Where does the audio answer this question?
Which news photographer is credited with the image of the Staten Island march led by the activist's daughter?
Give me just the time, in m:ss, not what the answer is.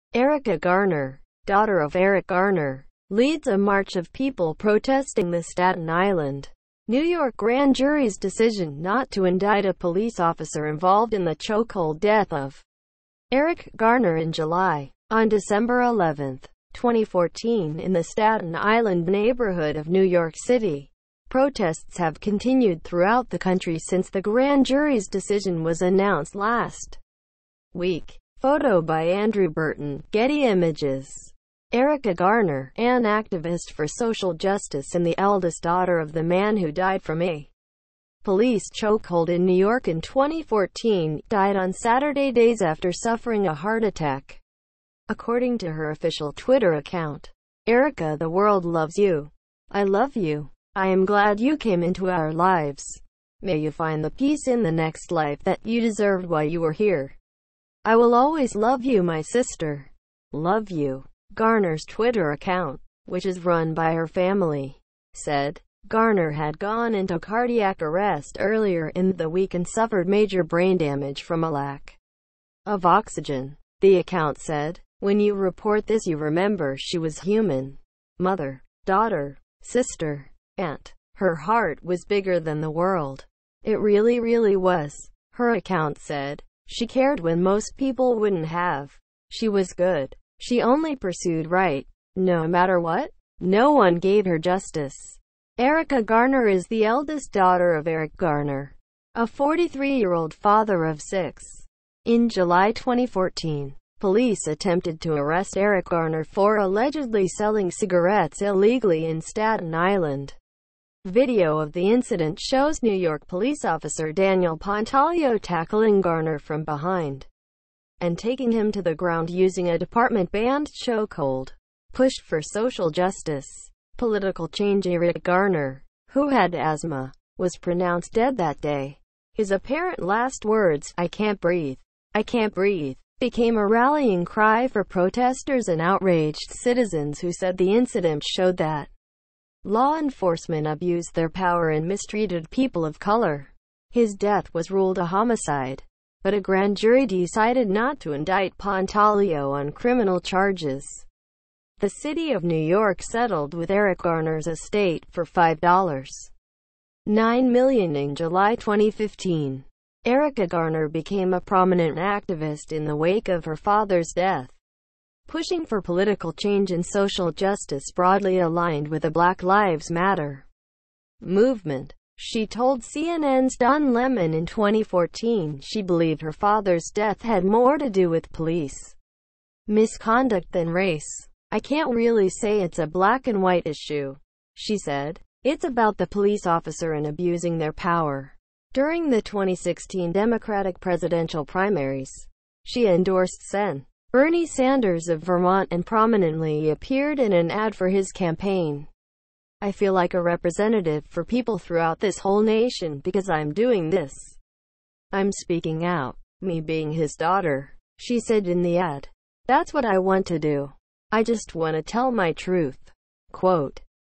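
0:29.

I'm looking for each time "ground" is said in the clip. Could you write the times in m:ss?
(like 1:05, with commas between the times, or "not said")
1:58.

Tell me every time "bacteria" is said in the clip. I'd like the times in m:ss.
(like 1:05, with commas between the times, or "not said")
not said.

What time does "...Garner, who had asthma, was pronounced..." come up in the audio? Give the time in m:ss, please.
2:05.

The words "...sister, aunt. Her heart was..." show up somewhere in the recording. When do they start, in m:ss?
1:19.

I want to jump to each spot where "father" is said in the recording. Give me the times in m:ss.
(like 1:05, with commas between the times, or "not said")
1:40, 2:43, 2:56.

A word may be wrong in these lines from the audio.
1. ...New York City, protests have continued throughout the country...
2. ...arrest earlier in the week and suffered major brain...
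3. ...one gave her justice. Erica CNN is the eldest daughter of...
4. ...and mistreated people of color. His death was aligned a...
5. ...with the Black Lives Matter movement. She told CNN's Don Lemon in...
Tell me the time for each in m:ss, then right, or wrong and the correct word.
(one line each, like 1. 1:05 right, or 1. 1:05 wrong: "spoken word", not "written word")
1. 0:19 right
2. 1:07 right
3. 1:33 wrong: "Garner", not "CNN"
4. 2:21 wrong: "ruled", not "aligned"
5. 2:48 right.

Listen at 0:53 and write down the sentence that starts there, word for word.
May you find the peace in the next life that you deserved while you were here.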